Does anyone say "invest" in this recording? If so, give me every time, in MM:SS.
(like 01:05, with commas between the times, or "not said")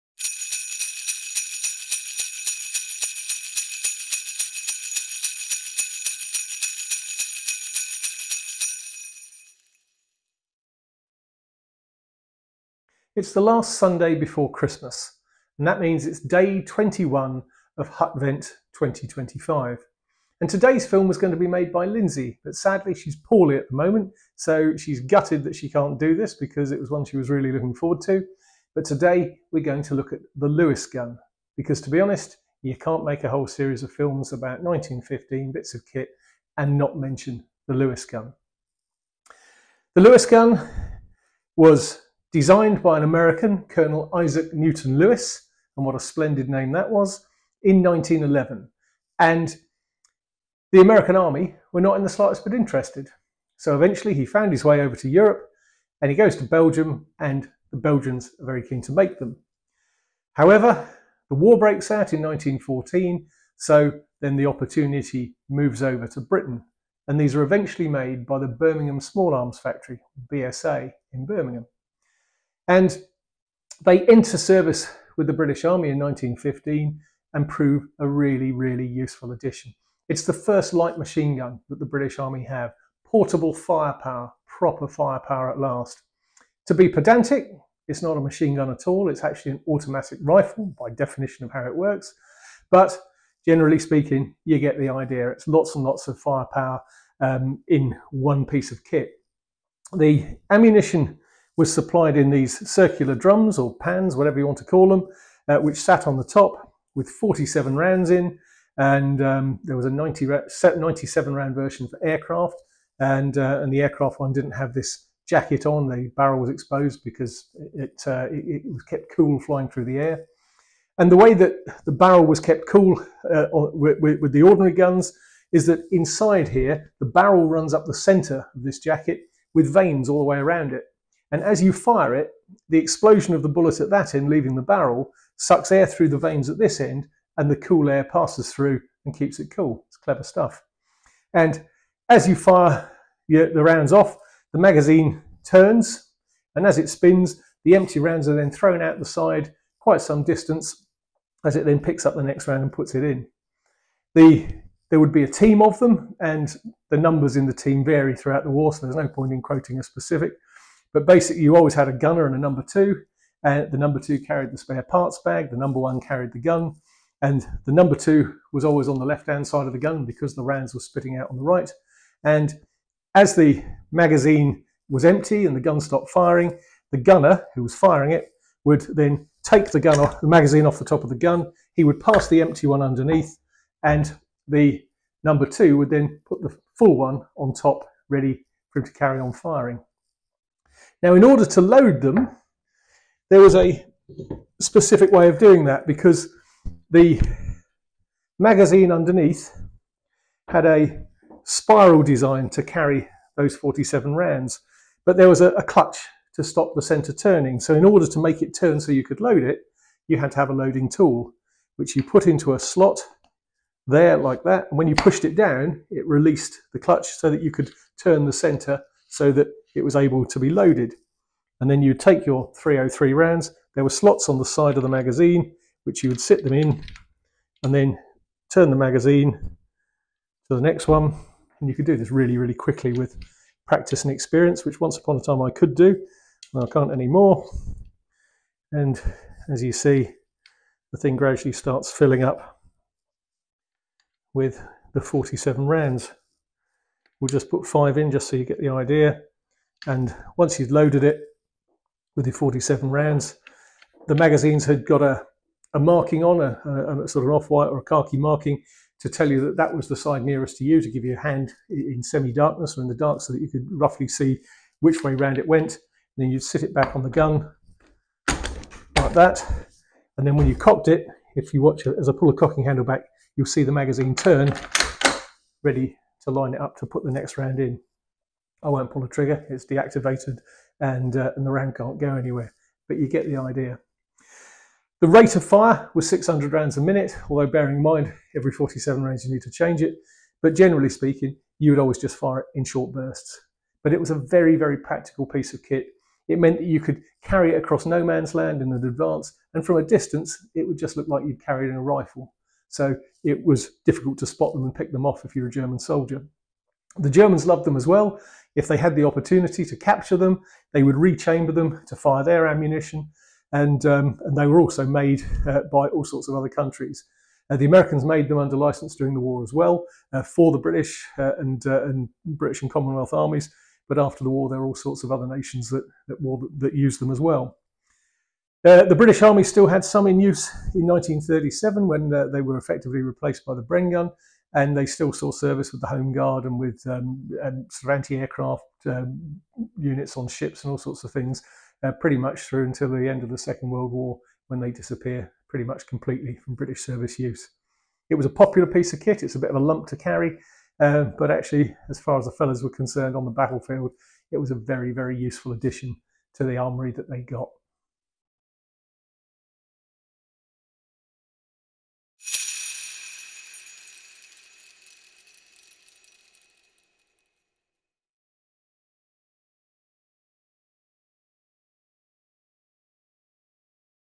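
not said.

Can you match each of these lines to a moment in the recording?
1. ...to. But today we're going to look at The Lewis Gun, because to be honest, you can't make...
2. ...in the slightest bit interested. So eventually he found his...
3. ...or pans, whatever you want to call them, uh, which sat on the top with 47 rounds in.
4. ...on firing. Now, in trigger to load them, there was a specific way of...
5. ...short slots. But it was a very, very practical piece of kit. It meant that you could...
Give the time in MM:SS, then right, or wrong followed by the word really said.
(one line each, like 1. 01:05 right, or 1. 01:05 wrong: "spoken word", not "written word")
1. 00:28 right
2. 00:51 right
3. 01:43 right
4. 03:09 wrong: "order", not "trigger"
5. 04:52 wrong: "bursts", not "slots".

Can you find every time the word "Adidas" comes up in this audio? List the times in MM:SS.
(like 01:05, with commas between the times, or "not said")
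not said.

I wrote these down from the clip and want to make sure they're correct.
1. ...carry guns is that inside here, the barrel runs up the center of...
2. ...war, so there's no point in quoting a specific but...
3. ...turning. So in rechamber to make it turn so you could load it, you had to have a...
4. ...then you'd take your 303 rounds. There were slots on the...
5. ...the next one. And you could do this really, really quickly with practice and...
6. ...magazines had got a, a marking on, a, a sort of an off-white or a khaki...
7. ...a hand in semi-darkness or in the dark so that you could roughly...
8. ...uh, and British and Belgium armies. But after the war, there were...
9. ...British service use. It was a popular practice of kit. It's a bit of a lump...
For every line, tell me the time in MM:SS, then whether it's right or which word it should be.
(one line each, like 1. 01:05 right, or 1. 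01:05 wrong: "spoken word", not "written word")
1. 02:04 wrong: "ordinary", not "carry"
2. 02:38 right
3. 03:27 wrong: "order", not "rechamber"
4. 03:41 right
5. 03:50 right
6. 04:14 right
7. 04:21 right
8. 05:21 wrong: "Commonwealth", not "Belgium"
9. 05:46 wrong: "piece", not "practice".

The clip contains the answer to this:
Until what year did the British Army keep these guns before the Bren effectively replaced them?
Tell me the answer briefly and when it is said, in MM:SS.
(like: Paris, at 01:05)
1937, at 05:30.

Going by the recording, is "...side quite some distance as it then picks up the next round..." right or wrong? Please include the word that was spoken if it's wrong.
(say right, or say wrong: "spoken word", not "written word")
right.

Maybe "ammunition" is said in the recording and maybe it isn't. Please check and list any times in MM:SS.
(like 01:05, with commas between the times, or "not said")
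01:40, 05:12.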